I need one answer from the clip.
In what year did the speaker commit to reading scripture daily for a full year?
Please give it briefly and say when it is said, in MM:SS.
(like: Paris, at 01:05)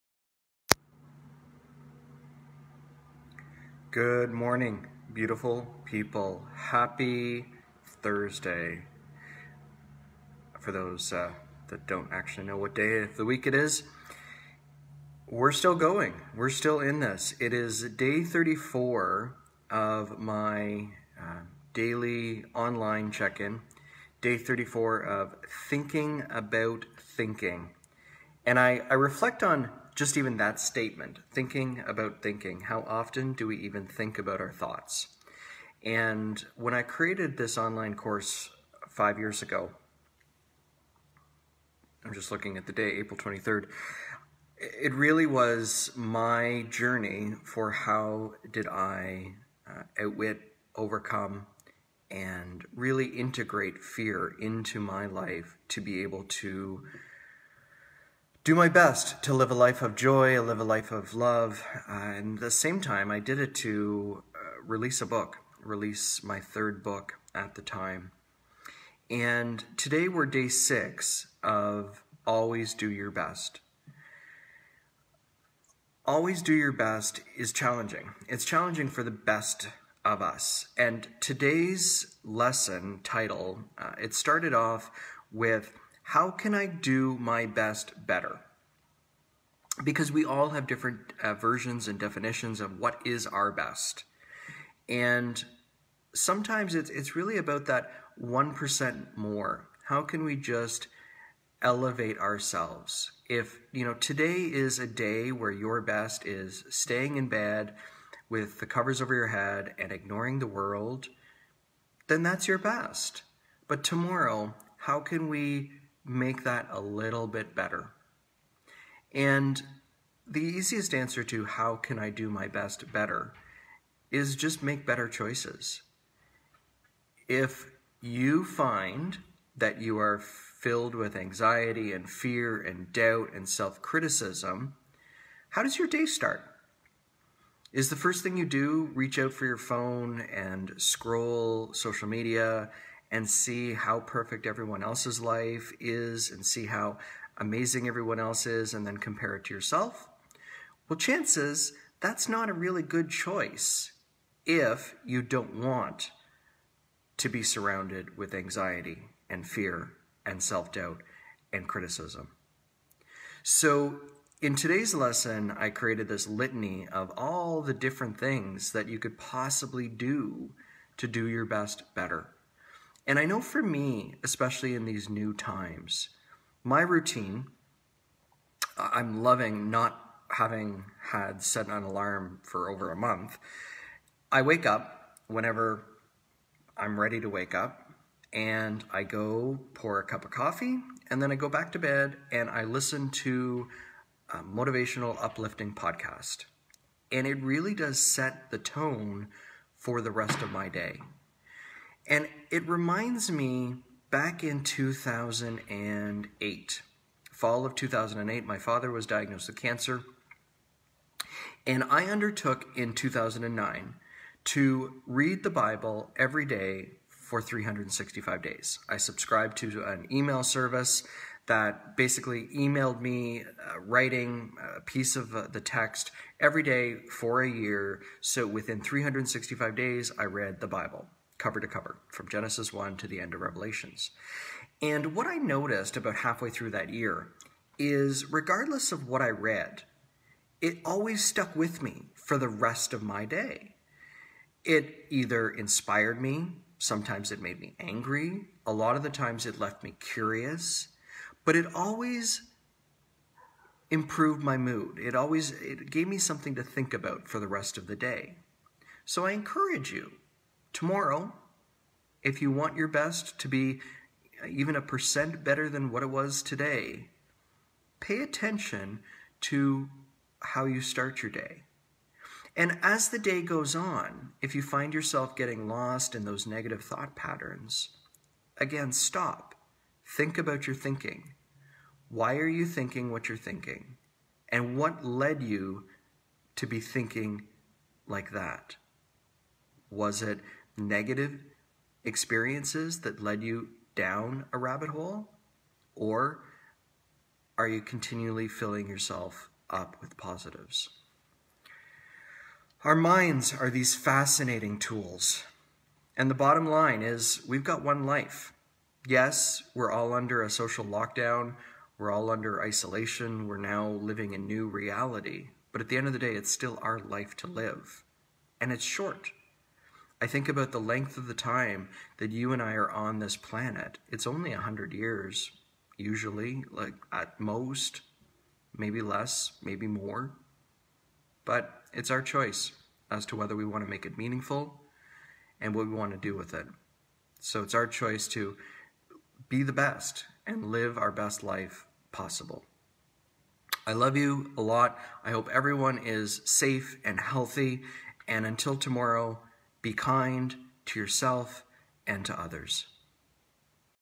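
2009, at 03:32.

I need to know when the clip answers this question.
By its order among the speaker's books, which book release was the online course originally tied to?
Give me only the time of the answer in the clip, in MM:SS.
01:06.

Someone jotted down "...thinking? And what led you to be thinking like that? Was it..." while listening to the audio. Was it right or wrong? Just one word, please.
right.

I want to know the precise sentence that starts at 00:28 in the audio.
And I, I reflect on just even that statement, thinking about thinking, how often do we even think about our thoughts?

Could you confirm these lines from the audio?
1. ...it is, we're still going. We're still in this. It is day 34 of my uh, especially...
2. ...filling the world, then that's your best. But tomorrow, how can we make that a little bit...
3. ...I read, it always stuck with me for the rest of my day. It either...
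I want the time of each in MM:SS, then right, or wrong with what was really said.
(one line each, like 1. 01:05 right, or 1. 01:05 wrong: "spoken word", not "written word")
1. 00:13 wrong: "daily", not "especially"
2. 01:49 wrong: "ignoring", not "filling"
3. 03:59 right.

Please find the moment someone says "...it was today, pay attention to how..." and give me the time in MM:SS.
04:26.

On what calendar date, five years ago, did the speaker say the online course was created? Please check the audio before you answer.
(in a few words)
April 23rd.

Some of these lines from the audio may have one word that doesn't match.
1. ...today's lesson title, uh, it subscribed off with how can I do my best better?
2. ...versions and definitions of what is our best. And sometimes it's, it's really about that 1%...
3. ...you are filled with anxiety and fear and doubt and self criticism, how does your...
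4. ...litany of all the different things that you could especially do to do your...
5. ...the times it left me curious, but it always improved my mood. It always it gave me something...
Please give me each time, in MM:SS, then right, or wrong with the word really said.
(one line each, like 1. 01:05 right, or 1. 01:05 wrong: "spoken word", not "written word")
1. 01:21 wrong: "started", not "subscribed"
2. 01:31 right
3. 02:09 right
4. 02:46 wrong: "possibly", not "especially"
5. 04:09 right.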